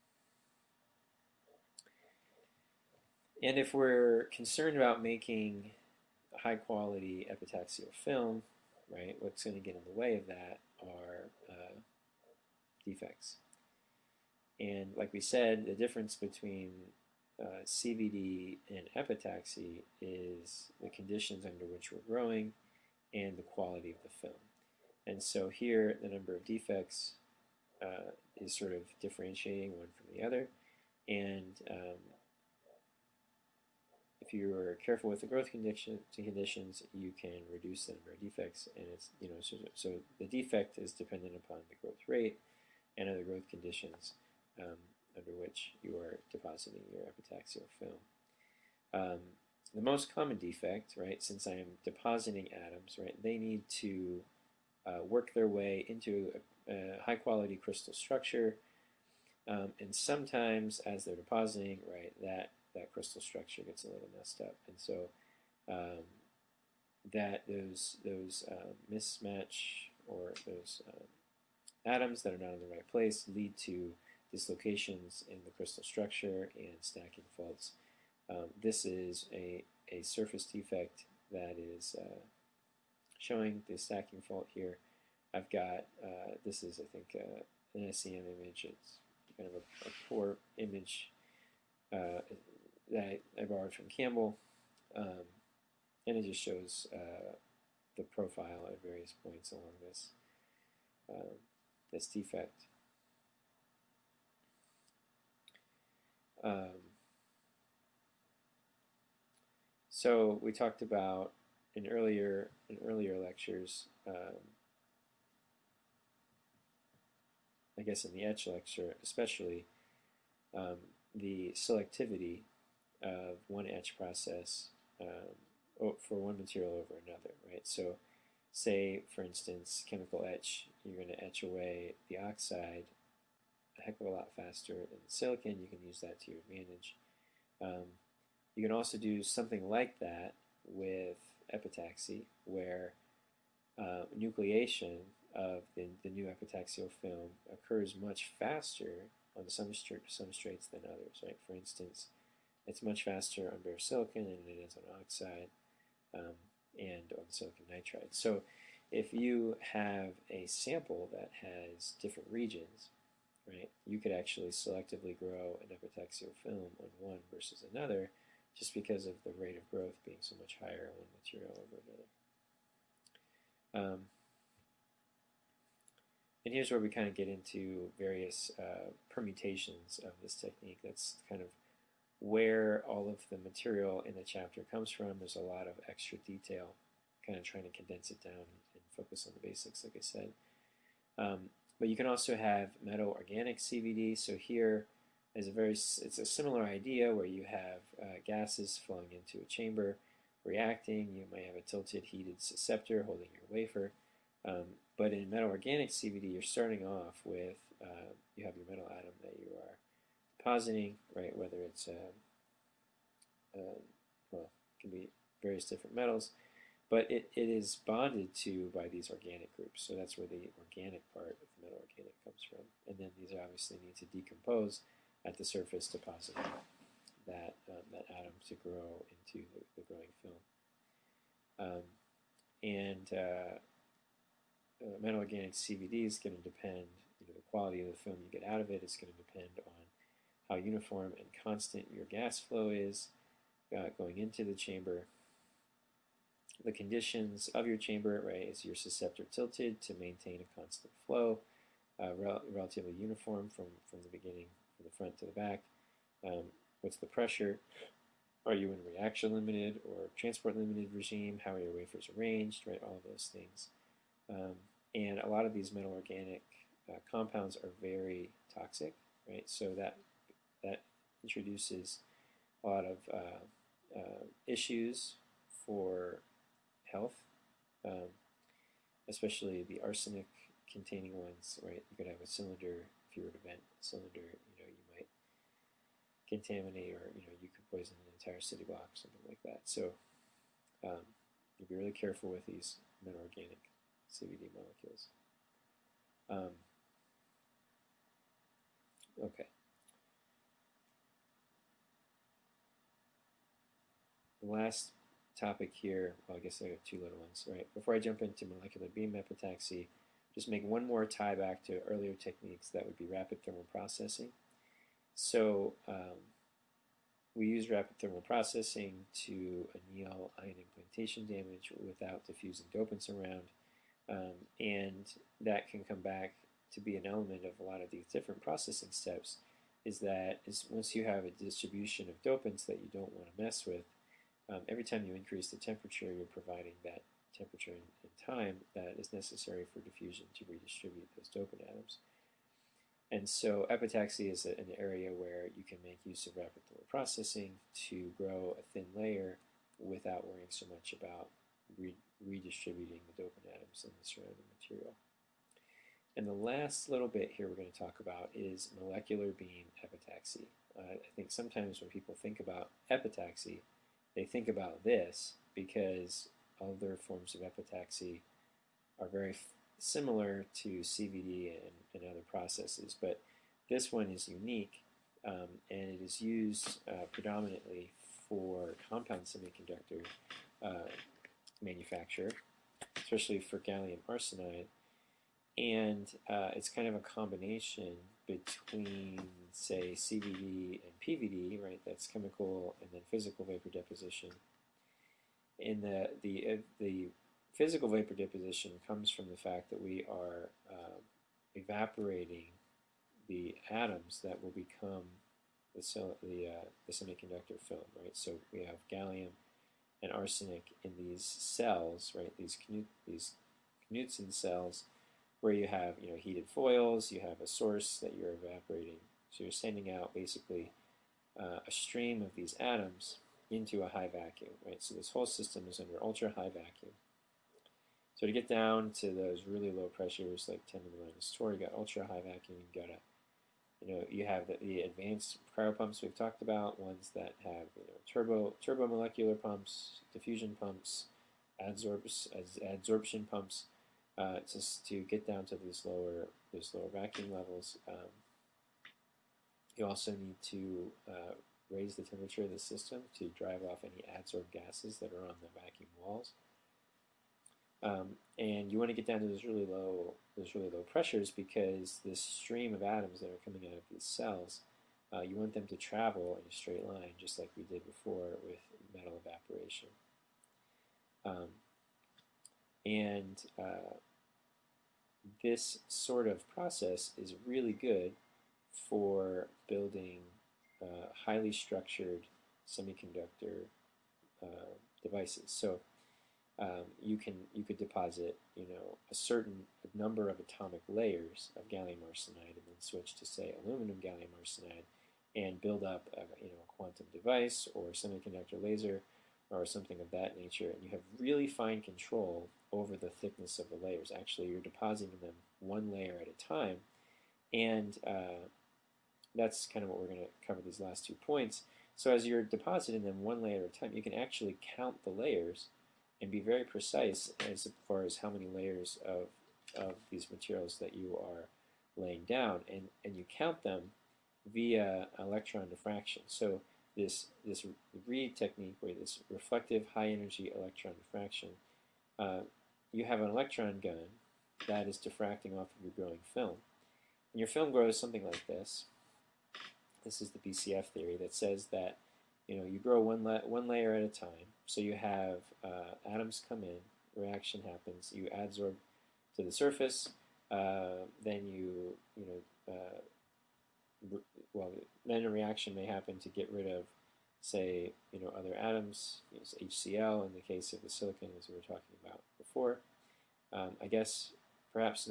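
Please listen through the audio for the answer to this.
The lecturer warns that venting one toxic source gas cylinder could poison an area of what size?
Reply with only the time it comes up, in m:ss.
4:48.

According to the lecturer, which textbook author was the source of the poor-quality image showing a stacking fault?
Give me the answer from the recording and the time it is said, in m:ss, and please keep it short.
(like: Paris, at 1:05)
Campbell, at 1:33.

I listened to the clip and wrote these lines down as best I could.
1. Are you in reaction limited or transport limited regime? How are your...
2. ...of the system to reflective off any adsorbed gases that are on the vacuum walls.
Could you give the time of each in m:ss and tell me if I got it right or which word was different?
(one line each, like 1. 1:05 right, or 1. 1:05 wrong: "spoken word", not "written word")
1. 4:18 right
2. 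7:32 wrong: "drive", not "reflective".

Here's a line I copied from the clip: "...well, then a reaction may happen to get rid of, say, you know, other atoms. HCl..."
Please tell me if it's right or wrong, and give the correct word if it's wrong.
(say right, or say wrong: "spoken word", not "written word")
right.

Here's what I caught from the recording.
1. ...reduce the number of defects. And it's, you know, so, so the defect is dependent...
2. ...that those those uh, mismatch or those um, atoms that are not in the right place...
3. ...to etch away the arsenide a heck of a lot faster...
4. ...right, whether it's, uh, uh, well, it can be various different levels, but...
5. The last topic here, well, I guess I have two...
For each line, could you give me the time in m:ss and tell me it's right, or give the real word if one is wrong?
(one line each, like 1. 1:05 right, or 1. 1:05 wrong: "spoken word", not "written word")
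1. 0:37 right
2. 1:07 right
3. 2:11 wrong: "oxide", not "arsenide"
4. 3:31 wrong: "metals", not "levels"
5. 5:04 right.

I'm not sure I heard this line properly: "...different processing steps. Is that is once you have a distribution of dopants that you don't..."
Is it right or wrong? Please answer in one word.
right.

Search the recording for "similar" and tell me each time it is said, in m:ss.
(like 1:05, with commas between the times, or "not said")
3:16, 6:09.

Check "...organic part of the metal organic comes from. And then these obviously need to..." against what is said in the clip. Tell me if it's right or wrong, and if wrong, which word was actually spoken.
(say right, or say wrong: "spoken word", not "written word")
right.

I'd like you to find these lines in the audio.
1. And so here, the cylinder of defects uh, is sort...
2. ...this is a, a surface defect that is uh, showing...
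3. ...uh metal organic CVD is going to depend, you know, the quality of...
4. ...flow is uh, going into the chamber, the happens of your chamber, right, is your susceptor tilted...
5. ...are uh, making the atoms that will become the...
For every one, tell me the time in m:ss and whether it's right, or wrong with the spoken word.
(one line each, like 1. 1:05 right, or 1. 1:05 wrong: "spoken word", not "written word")
1. 0:25 wrong: "number", not "cylinder"
2. 1:18 right
3. 3:54 right
4. 4:02 wrong: "conditions", not "happens"
5. 6:40 wrong: "evaporating", not "making".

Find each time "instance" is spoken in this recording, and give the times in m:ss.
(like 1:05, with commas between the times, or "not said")
2:09, 2:31.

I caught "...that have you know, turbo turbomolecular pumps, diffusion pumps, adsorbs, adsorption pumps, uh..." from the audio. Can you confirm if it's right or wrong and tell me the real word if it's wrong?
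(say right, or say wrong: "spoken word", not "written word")
right.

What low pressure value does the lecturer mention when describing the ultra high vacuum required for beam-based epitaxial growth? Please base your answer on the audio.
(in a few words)
10 to the minus 4.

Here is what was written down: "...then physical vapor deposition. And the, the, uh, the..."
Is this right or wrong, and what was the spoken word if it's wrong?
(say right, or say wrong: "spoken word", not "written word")
right.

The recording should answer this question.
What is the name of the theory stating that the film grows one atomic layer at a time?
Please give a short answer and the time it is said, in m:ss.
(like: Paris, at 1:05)
BCF theory, at 9:00.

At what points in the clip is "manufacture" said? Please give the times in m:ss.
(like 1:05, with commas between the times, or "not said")
6:21.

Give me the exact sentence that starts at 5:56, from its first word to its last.
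And the last little bit here we're going to talk about is molecular beam epitaxy.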